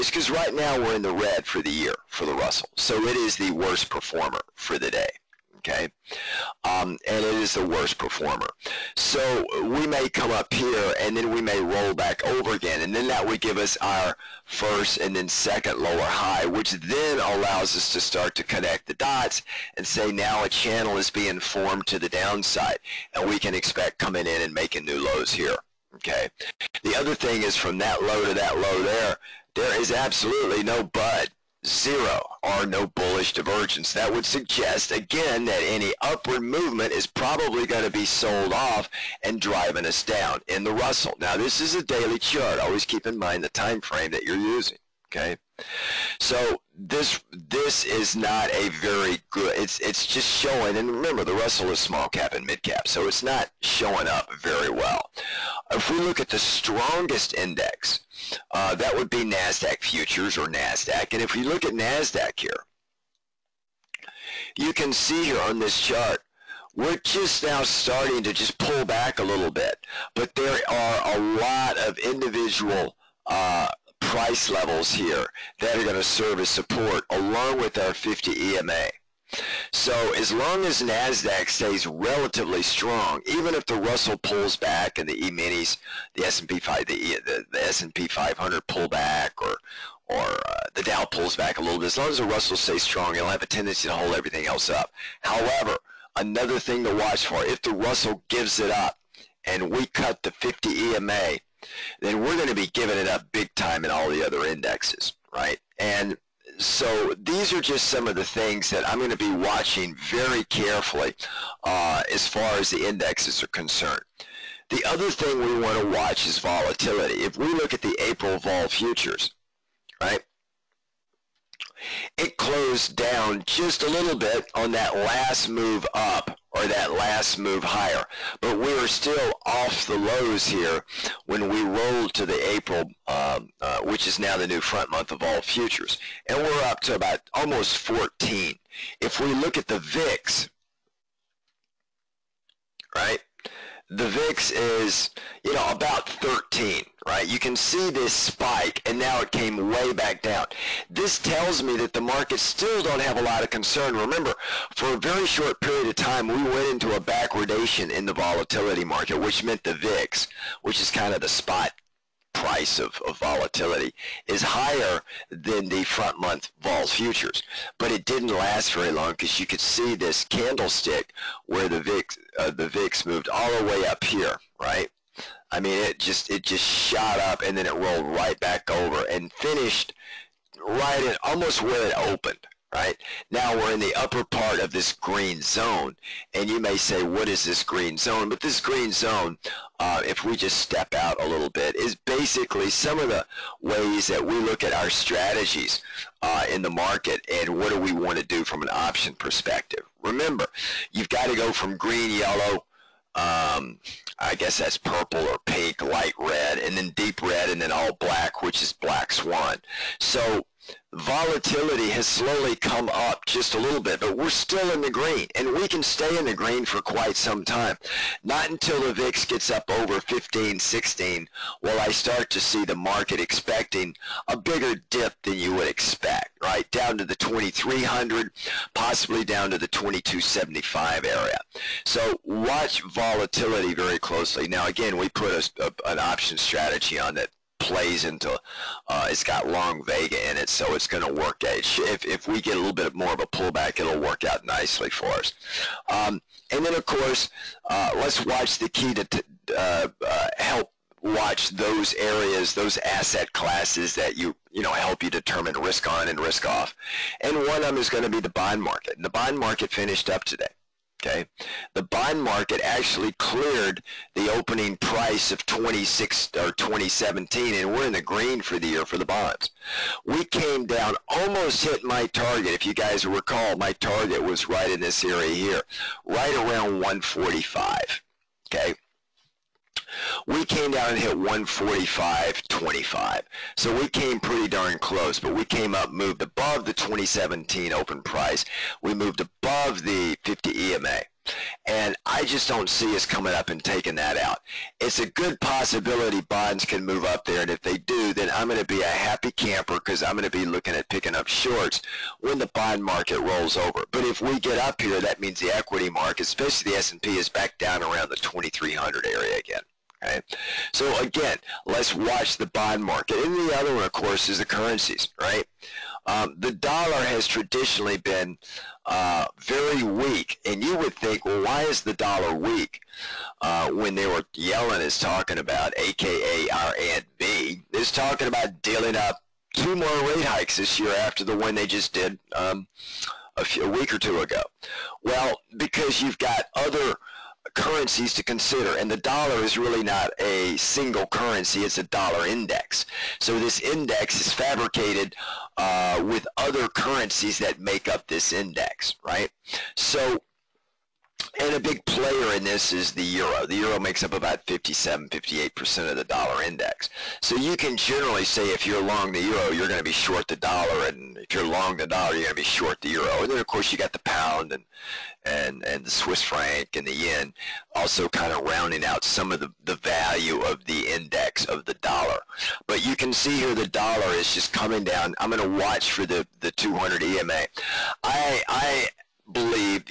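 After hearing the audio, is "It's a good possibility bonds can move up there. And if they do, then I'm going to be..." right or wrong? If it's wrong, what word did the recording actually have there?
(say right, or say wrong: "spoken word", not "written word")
right.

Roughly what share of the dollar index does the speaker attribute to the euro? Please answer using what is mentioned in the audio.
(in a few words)
57-58%.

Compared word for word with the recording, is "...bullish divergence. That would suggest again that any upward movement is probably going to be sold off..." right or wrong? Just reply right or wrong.
right.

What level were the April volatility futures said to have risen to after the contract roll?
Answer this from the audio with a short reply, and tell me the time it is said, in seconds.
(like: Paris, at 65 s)
almost 14, at 137 s.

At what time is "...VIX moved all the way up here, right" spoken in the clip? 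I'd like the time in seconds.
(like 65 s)
172 s.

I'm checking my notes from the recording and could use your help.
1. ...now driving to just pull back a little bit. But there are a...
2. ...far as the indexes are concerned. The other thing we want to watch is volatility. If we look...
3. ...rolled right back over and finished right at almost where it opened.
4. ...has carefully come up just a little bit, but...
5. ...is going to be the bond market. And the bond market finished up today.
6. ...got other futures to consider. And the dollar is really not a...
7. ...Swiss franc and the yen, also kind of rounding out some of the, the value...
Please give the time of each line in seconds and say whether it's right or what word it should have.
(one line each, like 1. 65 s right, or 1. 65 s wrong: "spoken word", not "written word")
1. 67 s wrong: "starting", not "driving"
2. 112 s right
3. 177 s right
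4. 211 s wrong: "slowly", not "carefully"
5. 257 s right
6. 336 s wrong: "currencies", not "futures"
7. 365 s right.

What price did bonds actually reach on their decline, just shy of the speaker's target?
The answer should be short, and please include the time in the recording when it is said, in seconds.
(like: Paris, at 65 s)
145.25, at 281 s.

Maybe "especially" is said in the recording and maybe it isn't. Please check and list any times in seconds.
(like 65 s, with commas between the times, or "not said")
306 s.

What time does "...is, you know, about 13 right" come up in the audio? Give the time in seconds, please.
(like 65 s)
144 s.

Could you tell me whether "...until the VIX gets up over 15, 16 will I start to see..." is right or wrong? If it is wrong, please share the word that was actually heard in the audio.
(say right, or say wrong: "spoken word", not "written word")
right.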